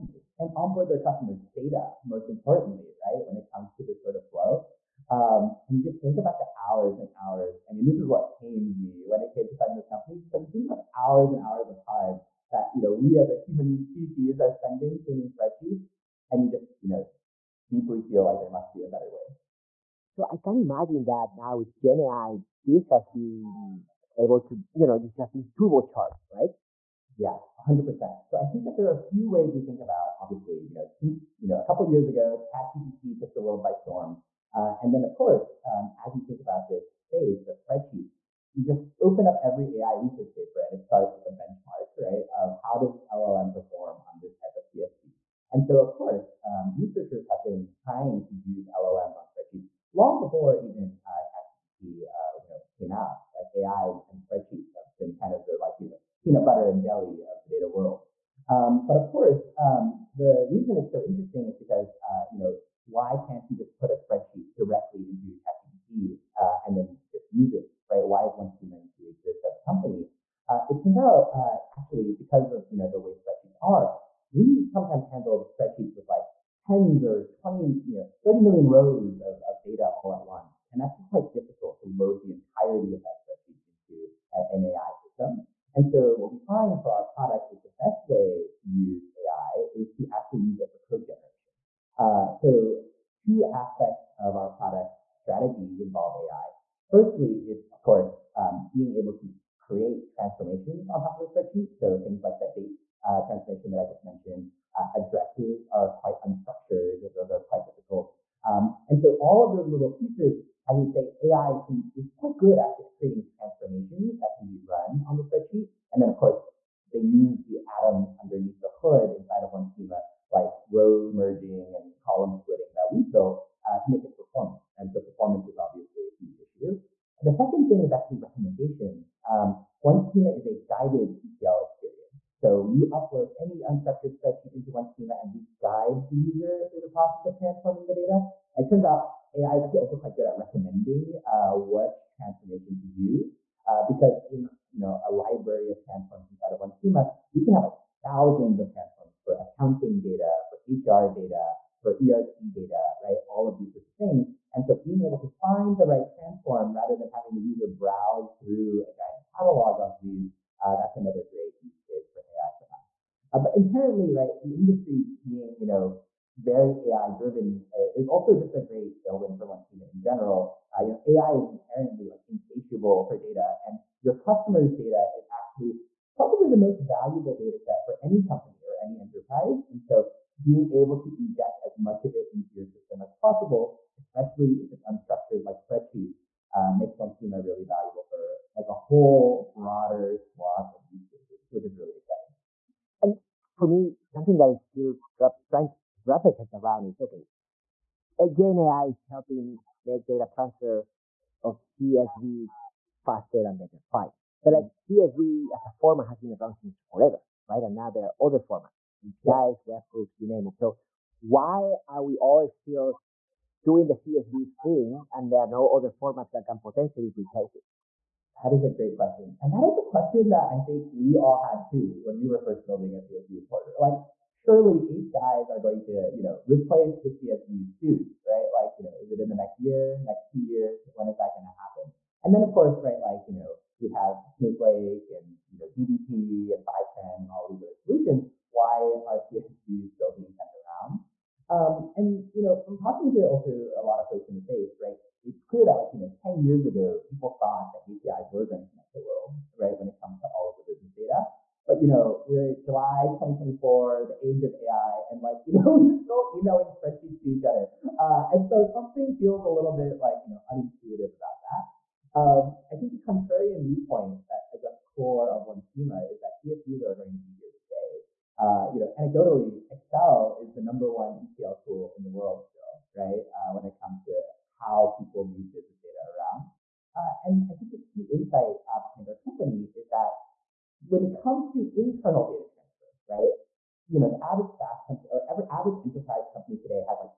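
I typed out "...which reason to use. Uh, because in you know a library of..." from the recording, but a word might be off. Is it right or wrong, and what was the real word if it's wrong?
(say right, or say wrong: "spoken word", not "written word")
wrong: "transformation", not "reason".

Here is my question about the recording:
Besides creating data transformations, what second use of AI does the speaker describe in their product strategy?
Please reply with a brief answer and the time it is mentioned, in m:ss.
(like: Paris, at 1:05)
recommendations, at 2:08.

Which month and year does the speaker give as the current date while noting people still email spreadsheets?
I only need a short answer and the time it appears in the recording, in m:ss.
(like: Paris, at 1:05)
July 2024, at 4:12.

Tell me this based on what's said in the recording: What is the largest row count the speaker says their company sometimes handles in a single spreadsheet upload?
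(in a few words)
30 million.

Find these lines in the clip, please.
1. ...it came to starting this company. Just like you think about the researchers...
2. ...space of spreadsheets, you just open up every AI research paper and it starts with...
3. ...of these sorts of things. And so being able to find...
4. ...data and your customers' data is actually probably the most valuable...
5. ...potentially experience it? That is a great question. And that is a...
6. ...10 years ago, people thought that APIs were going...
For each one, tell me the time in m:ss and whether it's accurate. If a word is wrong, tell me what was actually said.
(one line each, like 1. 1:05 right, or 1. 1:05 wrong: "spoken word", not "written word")
1. 0:09 wrong: "hours", not "researchers"
2. 0:36 right
3. 2:33 right
4. 2:53 right
5. 3:36 wrong: "replace", not "experience"
6. 4:06 right.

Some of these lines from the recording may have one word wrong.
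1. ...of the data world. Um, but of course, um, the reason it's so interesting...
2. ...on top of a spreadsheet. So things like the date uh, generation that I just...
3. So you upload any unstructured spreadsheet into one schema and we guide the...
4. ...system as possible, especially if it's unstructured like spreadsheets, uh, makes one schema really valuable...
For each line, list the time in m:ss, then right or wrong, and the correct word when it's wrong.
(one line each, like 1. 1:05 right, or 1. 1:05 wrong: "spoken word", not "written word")
1. 0:57 right
2. 1:40 wrong: "transformation", not "generation"
3. 2:12 right
4. 3:02 right.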